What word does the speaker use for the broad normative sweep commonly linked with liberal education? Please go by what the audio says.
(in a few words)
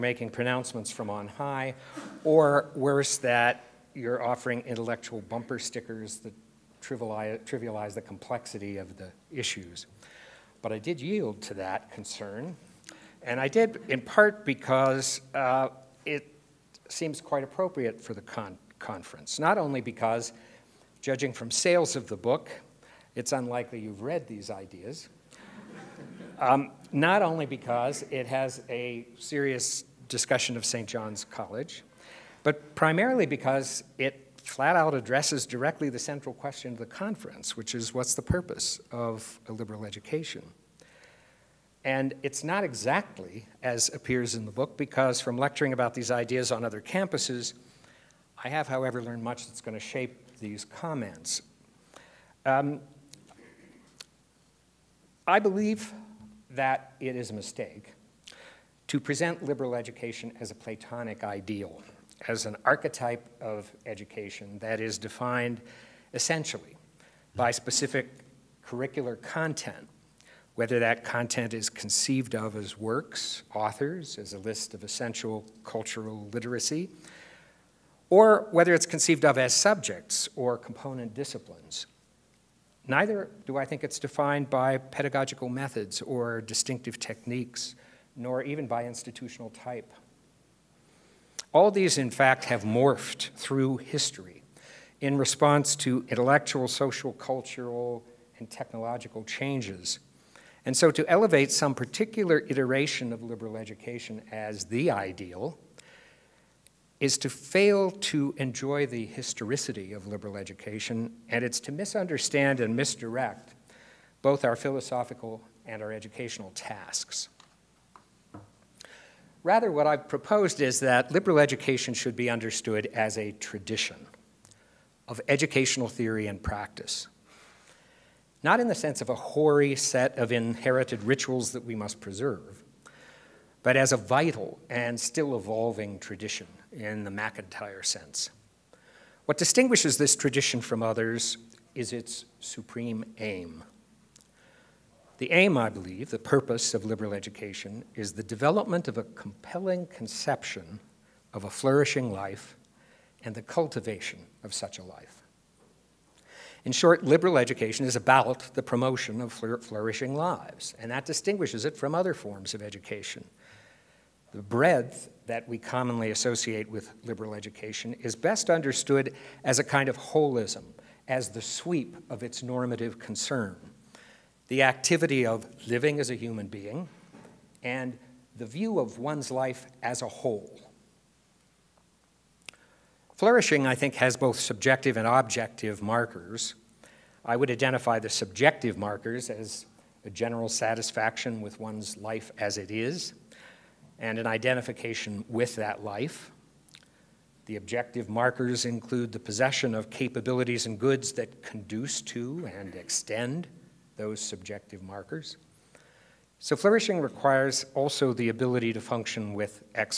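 holism.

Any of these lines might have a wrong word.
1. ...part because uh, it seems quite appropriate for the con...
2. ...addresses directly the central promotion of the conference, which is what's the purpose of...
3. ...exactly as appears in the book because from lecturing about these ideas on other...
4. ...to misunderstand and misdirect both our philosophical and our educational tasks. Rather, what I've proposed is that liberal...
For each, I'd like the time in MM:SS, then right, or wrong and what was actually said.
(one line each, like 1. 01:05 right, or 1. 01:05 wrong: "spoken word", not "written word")
1. 00:13 right
2. 00:34 wrong: "question", not "promotion"
3. 00:42 right
4. 01:51 right.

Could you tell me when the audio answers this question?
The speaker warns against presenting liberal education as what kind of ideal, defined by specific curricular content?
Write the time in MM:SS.
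01:00.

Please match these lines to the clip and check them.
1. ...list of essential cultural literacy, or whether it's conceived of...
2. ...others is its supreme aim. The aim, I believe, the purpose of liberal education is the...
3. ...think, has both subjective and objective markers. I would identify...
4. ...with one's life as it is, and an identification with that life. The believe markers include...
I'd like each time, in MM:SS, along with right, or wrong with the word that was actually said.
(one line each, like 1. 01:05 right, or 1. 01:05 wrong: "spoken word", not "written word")
1. 01:14 right
2. 02:20 right
3. 03:03 right
4. 03:11 wrong: "objective", not "believe".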